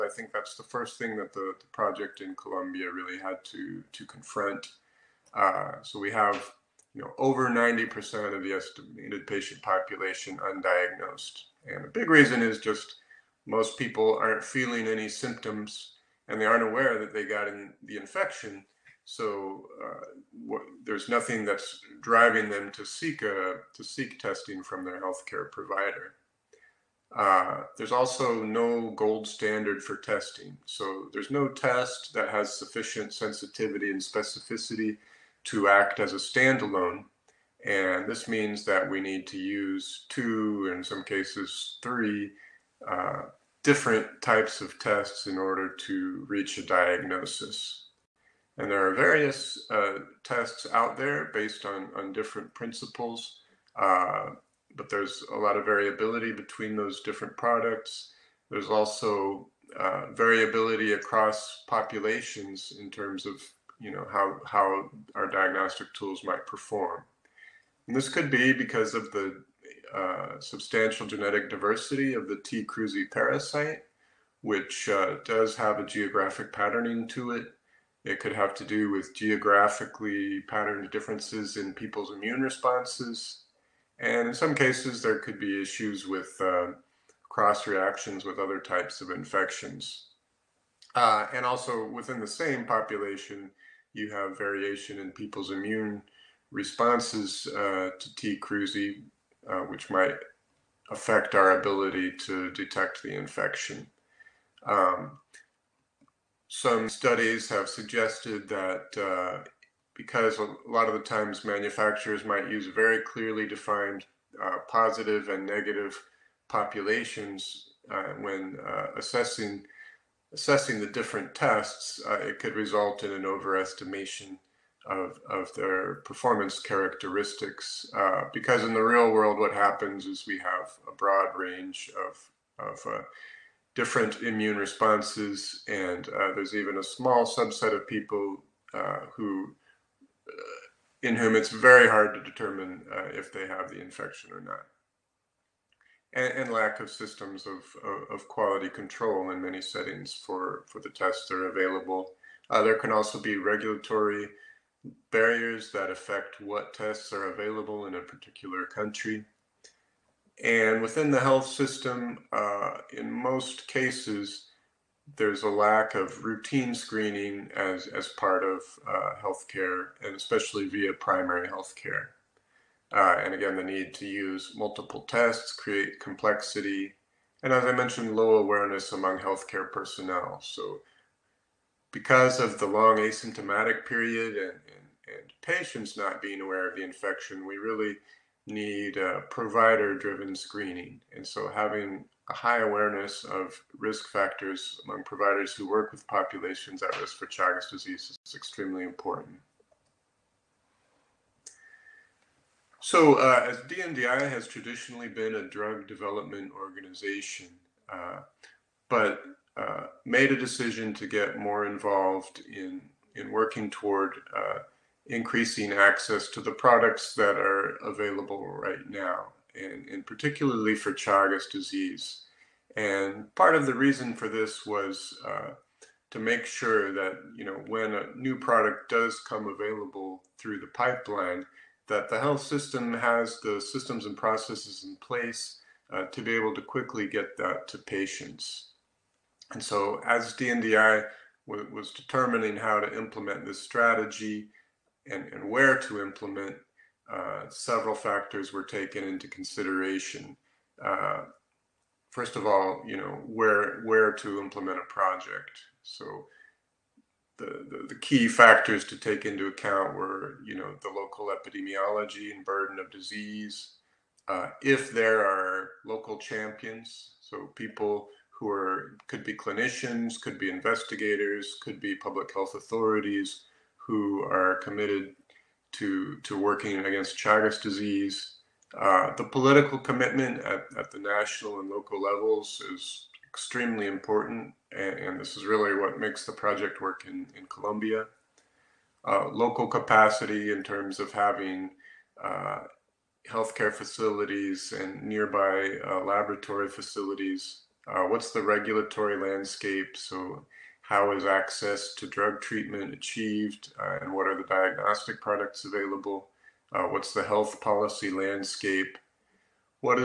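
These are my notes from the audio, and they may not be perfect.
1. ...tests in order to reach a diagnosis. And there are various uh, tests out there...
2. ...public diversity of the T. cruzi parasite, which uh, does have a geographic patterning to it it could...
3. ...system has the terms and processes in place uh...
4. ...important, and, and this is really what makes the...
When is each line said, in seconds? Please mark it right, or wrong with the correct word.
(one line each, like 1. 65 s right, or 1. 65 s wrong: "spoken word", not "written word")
1. 44 s right
2. 71 s wrong: "genetic", not "public"
3. 232 s wrong: "systems", not "terms"
4. 283 s right.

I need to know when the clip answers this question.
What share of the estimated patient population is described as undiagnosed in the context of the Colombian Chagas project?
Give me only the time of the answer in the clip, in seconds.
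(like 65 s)
7 s.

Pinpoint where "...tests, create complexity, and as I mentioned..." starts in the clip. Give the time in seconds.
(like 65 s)
175 s.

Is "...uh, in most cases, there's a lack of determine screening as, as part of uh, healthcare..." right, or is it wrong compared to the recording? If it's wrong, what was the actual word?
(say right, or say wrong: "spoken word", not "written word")
wrong: "routine", not "determine".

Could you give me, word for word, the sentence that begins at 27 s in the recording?
Uh, there's also no gold standard for testing.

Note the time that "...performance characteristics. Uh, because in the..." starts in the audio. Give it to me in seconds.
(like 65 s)
126 s.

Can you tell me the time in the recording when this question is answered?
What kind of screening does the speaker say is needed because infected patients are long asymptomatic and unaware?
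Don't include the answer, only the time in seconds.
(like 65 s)
189 s.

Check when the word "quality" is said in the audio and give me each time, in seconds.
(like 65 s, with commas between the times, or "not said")
148 s.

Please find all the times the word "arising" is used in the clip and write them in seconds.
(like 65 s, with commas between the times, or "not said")
not said.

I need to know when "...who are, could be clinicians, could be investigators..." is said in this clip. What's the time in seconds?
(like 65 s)
268 s.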